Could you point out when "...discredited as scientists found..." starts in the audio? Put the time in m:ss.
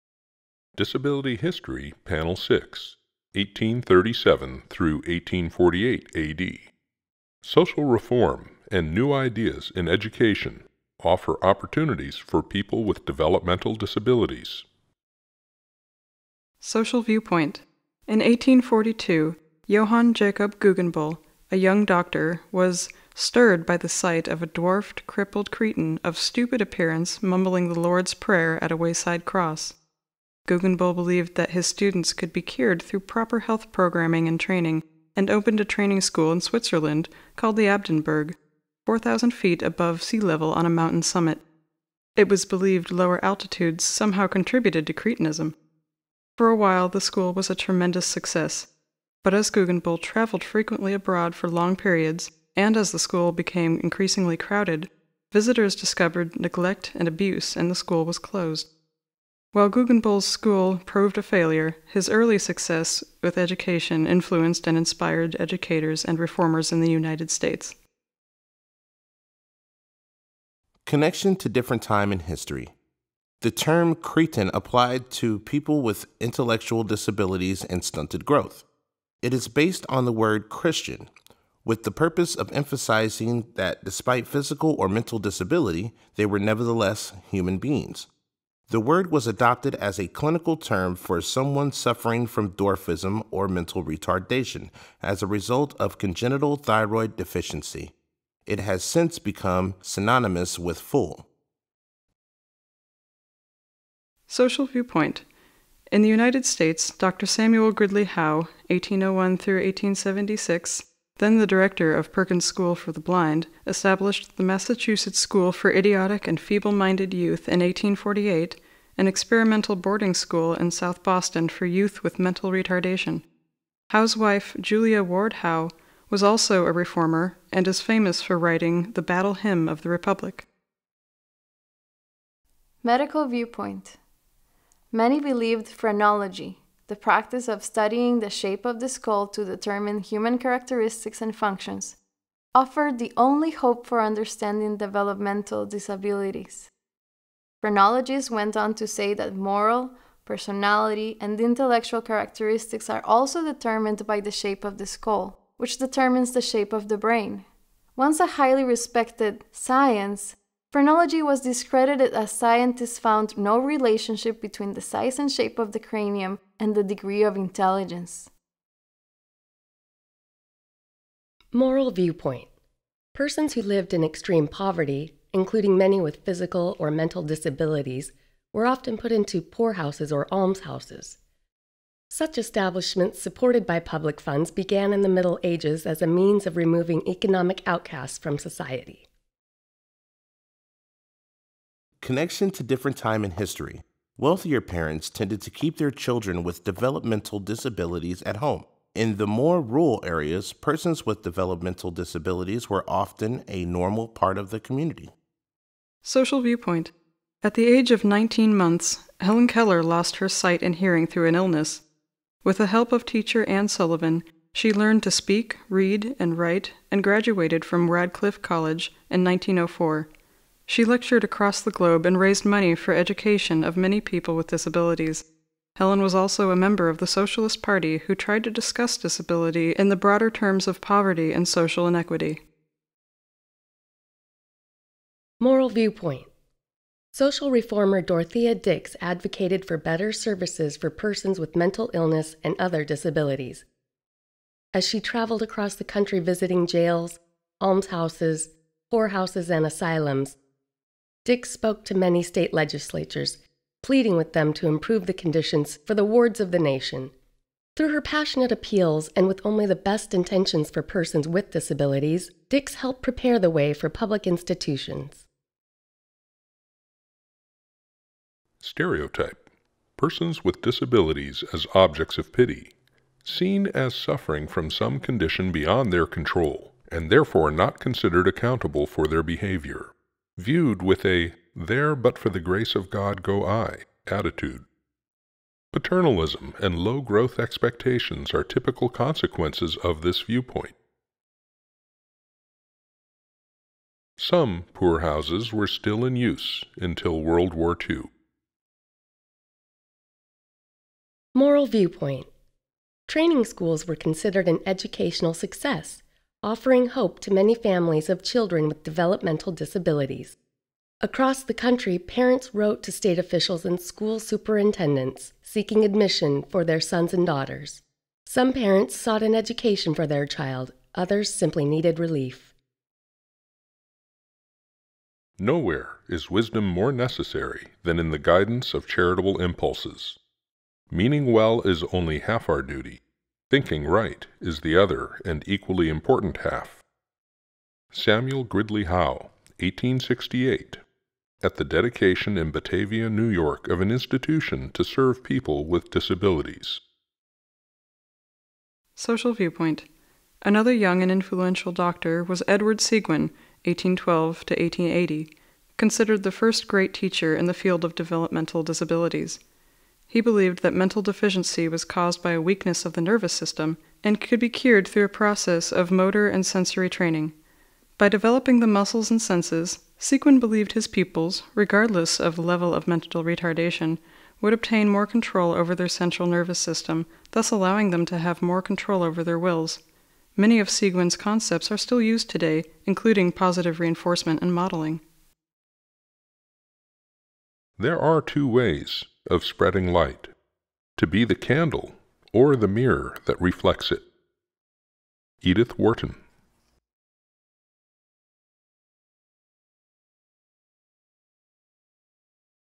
2:41.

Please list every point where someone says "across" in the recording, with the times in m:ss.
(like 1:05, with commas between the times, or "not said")
3:41, 4:05, 5:10.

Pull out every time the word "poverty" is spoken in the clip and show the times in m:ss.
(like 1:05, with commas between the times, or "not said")
2:54, 3:50.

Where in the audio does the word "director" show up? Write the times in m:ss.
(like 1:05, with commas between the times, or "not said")
1:51.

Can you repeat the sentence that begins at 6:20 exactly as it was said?
Many of Seguin's concepts are still used today, including positive reinforcement and modeling.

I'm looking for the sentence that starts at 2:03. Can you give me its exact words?
Howe's wife, Julia Ward Howe, was also a reformer and is famous for writing the Battle Hymn of the Republic.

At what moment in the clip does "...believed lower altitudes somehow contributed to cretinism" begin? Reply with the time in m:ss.
0:42.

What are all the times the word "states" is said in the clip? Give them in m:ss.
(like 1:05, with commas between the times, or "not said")
1:07, 1:46, 4:12, 5:12.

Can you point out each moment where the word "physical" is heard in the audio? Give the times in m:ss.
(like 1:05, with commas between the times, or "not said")
1:24, 2:56.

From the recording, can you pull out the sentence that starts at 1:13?
The term cretin applied to people with intellectual disabilities and stunted growth.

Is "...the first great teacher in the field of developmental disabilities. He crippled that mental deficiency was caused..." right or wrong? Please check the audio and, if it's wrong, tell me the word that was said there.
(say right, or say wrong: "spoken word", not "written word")
wrong: "believed", not "crippled".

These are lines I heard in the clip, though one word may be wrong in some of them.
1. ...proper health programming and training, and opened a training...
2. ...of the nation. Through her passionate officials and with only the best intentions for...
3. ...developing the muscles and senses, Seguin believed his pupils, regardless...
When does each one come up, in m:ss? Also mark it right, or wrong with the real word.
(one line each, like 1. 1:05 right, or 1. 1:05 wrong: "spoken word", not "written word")
1. 0:32 right
2. 4:16 wrong: "appeals", not "officials"
3. 6:08 right.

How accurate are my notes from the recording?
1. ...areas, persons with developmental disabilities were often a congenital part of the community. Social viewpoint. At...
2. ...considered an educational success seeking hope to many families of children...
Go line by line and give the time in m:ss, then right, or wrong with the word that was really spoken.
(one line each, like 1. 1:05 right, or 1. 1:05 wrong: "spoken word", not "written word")
1. 3:20 wrong: "normal", not "congenital"
2. 5:03 wrong: "offering", not "seeking".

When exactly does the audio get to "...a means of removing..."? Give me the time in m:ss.
3:06.